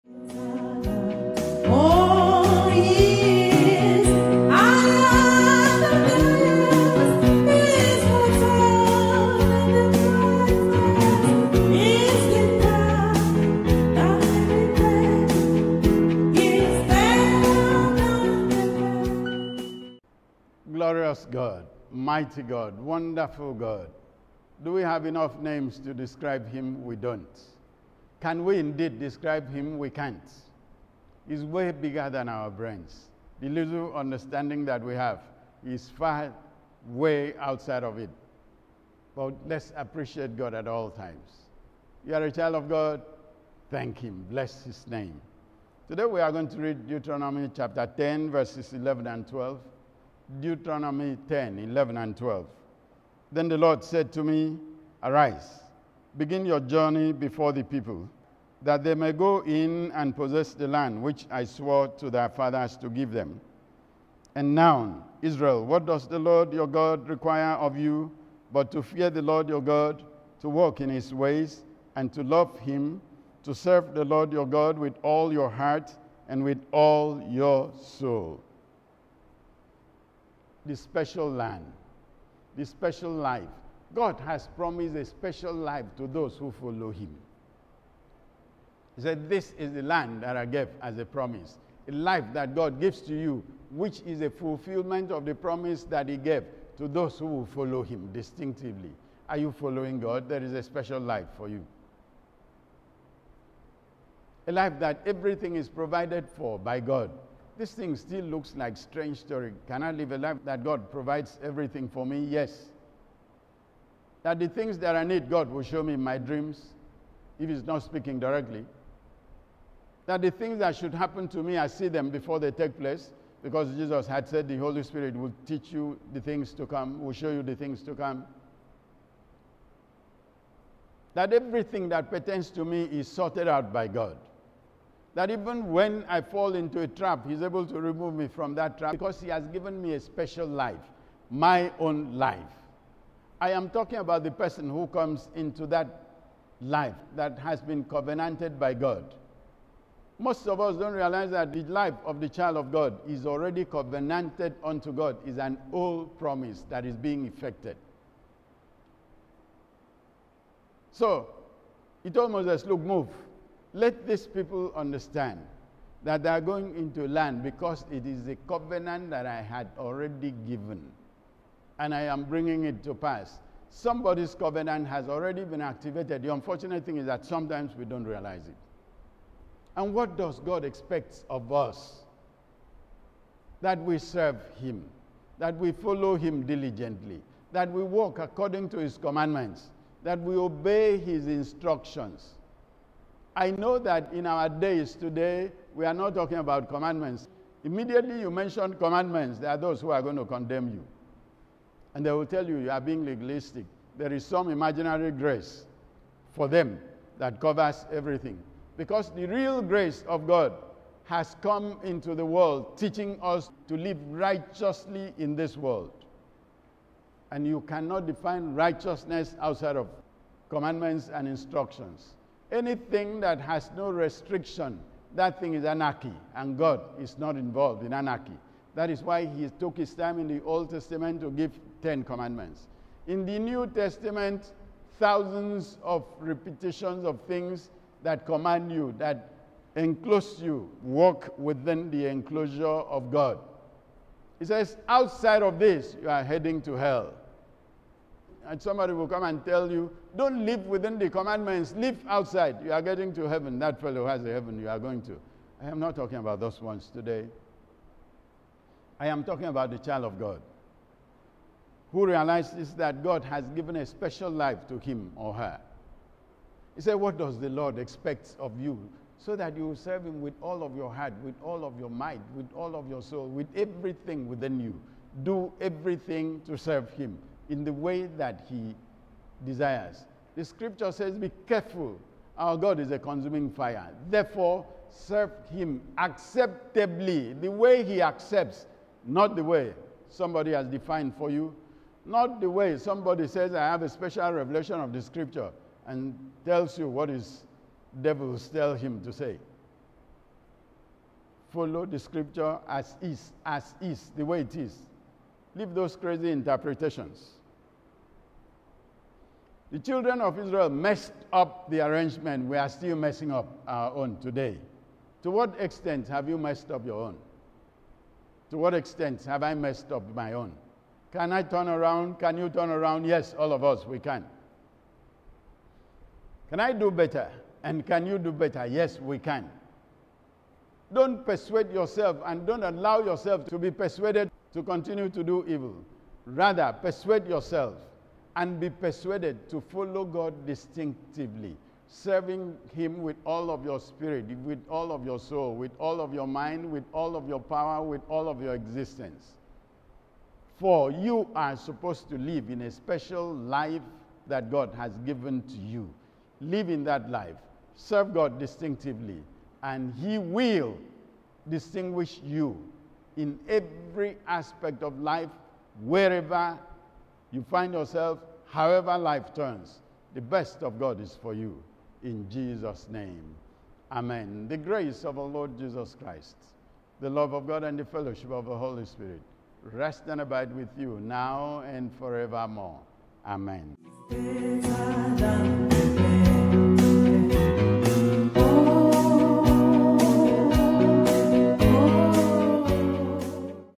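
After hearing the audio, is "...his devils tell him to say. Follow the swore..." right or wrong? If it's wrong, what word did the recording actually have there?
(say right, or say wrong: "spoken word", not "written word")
wrong: "scripture", not "swore".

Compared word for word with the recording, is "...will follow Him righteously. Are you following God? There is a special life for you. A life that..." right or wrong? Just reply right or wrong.
wrong.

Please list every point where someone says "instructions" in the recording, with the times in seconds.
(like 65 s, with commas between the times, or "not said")
191 s, 221 s.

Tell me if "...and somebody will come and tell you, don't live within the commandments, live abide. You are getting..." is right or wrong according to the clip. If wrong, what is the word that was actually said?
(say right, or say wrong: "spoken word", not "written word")
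wrong: "outside", not "abide".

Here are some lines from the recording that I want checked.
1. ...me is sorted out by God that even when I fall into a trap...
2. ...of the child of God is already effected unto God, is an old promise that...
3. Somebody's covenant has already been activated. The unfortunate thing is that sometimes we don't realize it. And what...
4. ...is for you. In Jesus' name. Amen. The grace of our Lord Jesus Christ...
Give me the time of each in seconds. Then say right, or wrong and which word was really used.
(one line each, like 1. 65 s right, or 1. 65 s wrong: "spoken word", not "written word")
1. 132 s right
2. 152 s wrong: "covenanted", not "effected"
3. 173 s right
4. 371 s right.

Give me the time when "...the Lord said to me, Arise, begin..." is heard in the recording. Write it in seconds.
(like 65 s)
53 s.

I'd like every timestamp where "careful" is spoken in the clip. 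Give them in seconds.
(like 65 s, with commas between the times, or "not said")
281 s.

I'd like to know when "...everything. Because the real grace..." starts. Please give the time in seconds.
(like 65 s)
207 s.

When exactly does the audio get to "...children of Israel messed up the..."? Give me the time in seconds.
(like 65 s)
309 s.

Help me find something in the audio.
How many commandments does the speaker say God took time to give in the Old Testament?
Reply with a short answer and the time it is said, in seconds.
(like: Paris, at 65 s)
10, at 231 s.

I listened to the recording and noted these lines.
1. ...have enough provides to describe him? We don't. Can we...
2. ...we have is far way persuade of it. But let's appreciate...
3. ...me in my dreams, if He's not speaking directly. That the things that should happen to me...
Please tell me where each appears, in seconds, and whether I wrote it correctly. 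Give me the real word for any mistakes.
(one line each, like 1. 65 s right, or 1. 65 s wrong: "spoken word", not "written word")
1. 24 s wrong: "names", not "provides"
2. 34 s wrong: "outside", not "persuade"
3. 115 s right.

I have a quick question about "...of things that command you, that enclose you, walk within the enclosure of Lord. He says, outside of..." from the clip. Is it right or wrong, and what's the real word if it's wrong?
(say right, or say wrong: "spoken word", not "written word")
wrong: "God", not "Lord".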